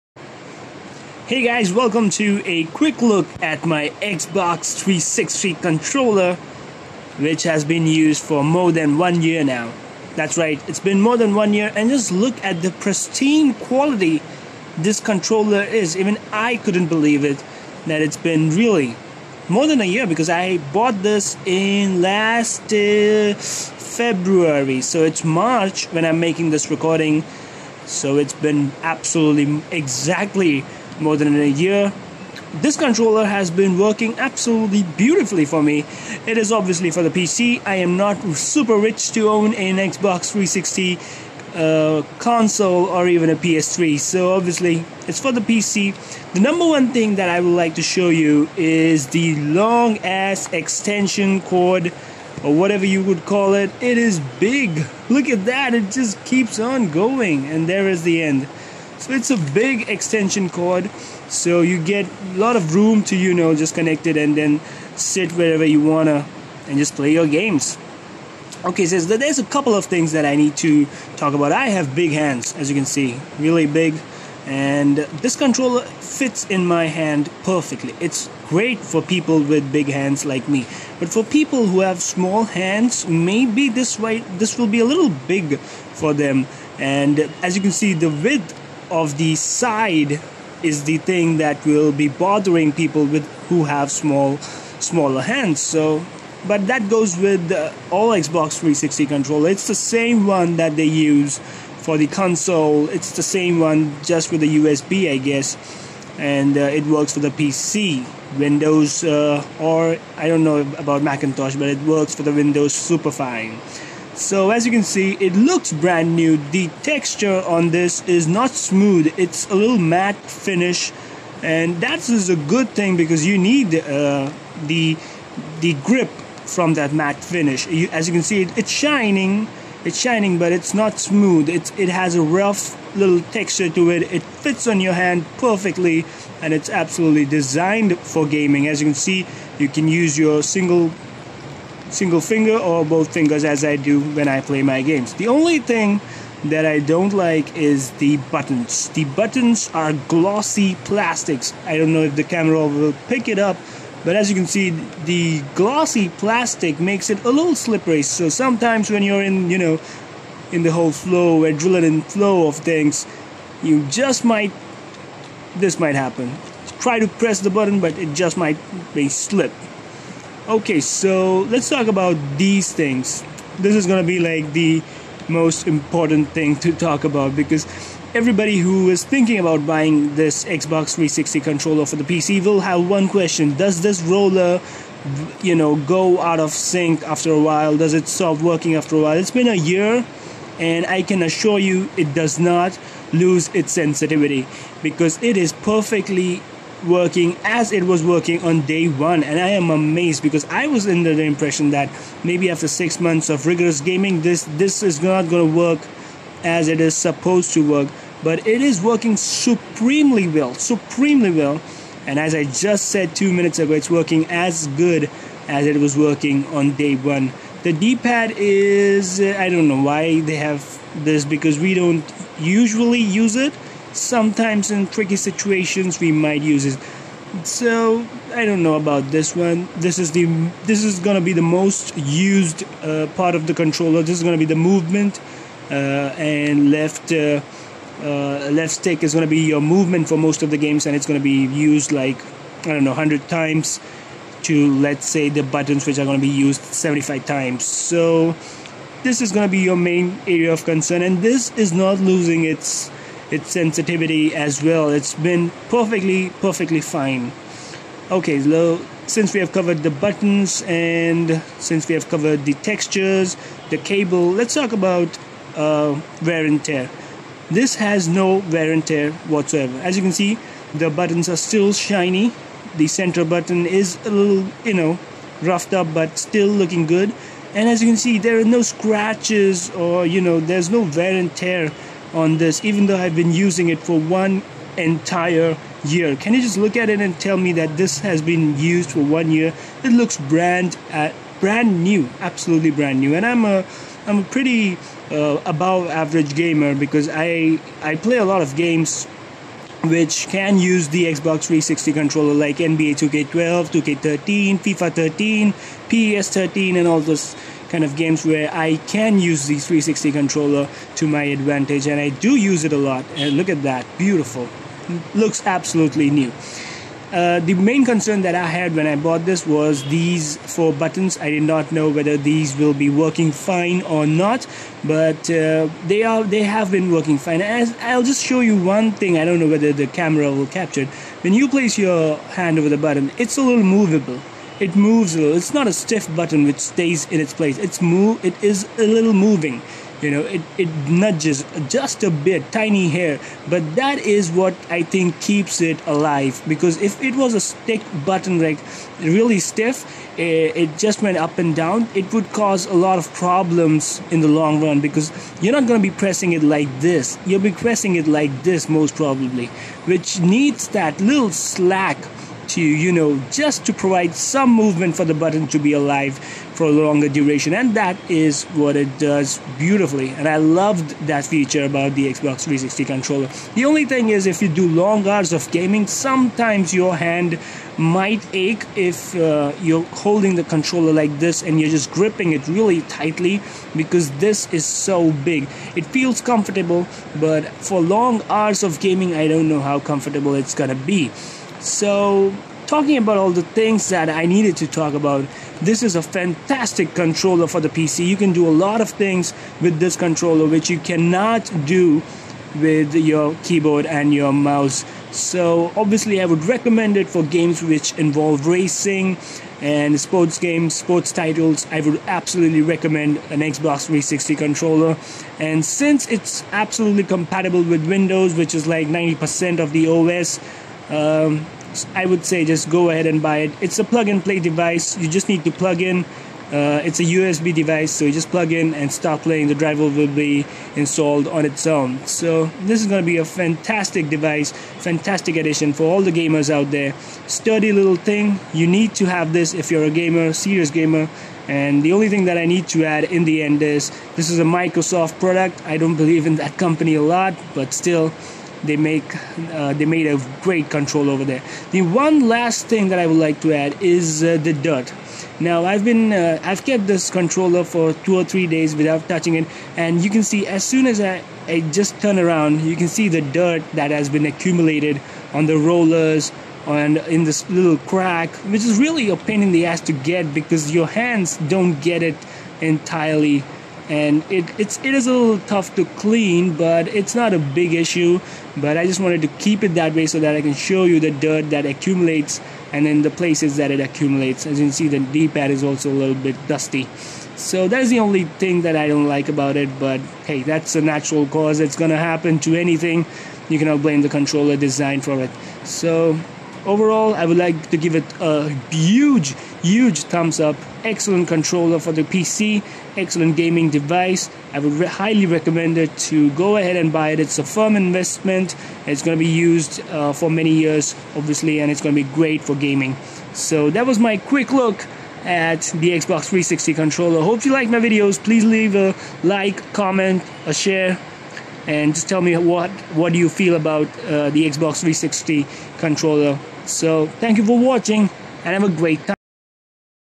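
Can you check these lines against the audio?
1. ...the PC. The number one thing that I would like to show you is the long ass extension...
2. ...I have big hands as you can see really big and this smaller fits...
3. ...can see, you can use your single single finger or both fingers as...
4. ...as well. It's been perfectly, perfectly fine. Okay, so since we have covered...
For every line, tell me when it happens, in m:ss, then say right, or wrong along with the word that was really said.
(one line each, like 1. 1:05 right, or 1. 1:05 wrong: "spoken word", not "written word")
1. 0:45 right
2. 1:11 wrong: "controller", not "smaller"
3. 2:18 right
4. 4:14 right.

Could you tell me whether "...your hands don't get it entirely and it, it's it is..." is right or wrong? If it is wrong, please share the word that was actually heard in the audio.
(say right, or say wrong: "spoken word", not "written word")
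right.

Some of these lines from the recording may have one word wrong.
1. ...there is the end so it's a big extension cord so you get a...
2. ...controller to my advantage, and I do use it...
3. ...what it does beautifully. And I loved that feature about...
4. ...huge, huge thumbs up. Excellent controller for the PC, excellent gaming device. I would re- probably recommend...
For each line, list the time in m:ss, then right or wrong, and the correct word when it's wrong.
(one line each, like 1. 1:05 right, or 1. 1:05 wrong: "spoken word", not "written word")
1. 0:57 right
2. 5:10 right
3. 6:08 right
4. 8:18 wrong: "highly", not "probably".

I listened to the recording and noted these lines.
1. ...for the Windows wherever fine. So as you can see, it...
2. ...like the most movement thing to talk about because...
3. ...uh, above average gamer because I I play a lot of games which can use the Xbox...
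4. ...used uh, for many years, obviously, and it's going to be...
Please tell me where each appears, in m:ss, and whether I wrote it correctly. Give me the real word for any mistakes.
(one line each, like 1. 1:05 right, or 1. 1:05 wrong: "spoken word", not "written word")
1. 1:52 wrong: "super", not "wherever"
2. 2:54 wrong: "important", not "movement"
3. 4:55 right
4. 8:29 right.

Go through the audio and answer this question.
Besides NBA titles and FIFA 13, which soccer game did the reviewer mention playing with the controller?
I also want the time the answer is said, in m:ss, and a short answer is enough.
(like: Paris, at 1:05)
PES 13, at 5:05.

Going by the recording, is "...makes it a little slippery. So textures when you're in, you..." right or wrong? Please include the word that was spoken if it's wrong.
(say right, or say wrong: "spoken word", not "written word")
wrong: "sometimes", not "textures".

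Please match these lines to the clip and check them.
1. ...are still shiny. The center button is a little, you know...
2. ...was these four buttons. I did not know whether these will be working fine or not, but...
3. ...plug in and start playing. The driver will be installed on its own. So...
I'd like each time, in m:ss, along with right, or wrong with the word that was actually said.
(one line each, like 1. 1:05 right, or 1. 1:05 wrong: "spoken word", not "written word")
1. 4:31 right
2. 5:19 right
3. 7:08 right.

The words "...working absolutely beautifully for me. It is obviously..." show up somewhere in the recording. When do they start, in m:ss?
0:33.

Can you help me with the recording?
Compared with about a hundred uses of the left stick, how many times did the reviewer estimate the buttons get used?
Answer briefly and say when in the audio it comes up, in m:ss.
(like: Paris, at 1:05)
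75, at 4:06.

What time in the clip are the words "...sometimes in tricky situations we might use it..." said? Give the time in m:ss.
3:43.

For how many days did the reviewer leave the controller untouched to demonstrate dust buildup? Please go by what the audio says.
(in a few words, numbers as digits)
2 or 3.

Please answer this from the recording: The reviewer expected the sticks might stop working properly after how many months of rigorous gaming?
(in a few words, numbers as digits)
6.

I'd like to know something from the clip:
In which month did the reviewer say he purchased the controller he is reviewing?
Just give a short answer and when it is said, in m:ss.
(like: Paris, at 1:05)
February, at 0:23.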